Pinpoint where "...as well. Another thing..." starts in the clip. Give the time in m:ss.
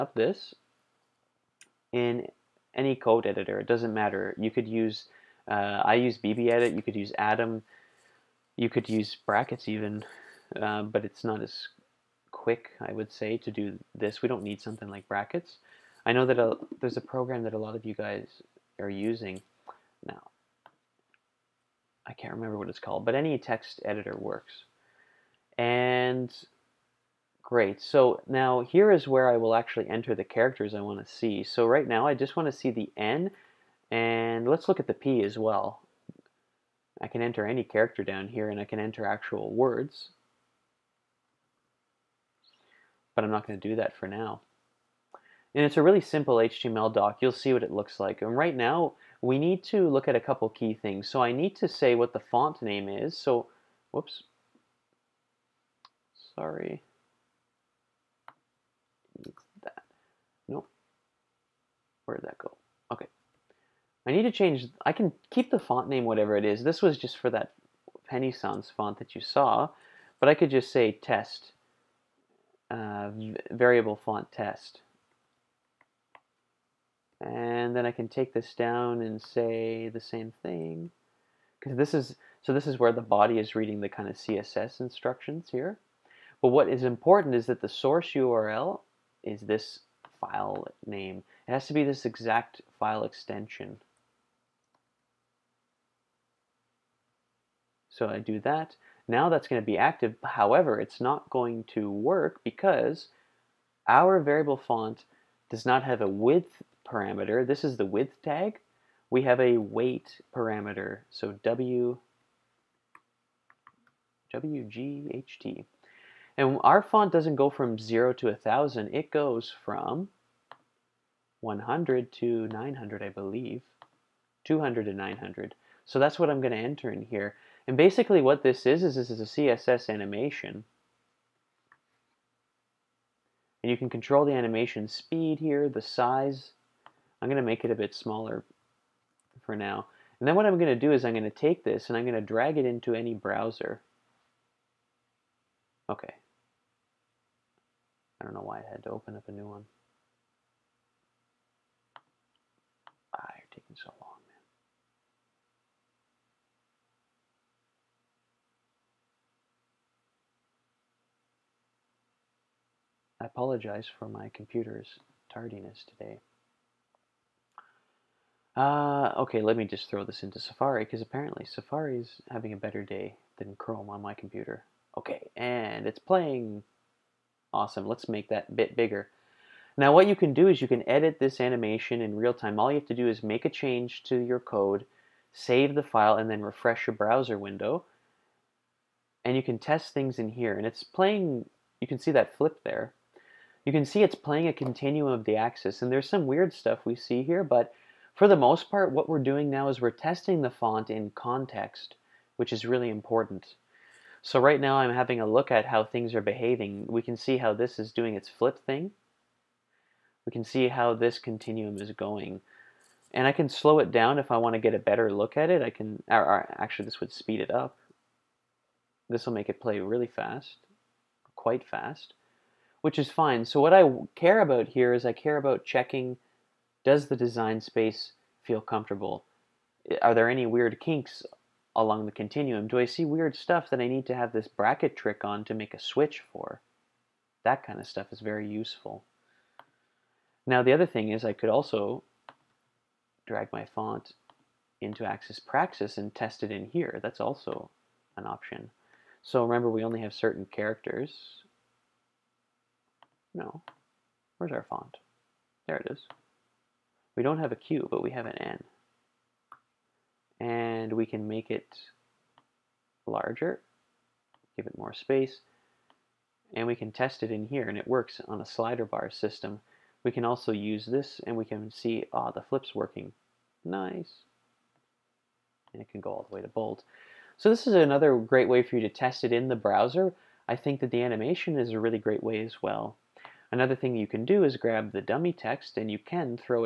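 4:42.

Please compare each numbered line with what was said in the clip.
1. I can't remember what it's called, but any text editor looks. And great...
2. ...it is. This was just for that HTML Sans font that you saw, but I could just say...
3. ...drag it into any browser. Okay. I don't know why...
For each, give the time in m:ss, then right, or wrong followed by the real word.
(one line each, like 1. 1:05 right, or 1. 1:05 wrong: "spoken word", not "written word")
1. 0:22 wrong: "works", not "looks"
2. 1:06 wrong: "Penny", not "HTML"
3. 2:22 right.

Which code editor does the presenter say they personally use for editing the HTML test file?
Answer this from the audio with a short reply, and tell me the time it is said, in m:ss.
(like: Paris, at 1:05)
BBEdit, at 0:06.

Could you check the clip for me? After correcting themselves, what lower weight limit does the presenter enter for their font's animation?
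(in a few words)
200.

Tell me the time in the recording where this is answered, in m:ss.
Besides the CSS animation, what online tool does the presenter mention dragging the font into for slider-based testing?
4:05.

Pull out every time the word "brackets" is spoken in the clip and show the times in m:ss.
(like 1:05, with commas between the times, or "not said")
0:09, 0:15, 3:54.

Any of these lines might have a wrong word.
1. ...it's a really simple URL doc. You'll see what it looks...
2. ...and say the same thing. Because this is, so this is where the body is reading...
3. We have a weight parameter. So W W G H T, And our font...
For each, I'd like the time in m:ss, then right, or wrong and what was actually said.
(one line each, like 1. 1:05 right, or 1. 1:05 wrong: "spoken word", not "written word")
1. 0:45 wrong: "HTML", not "URL"
2. 1:19 right
3. 1:49 right.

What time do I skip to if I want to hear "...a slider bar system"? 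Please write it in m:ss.
4:28.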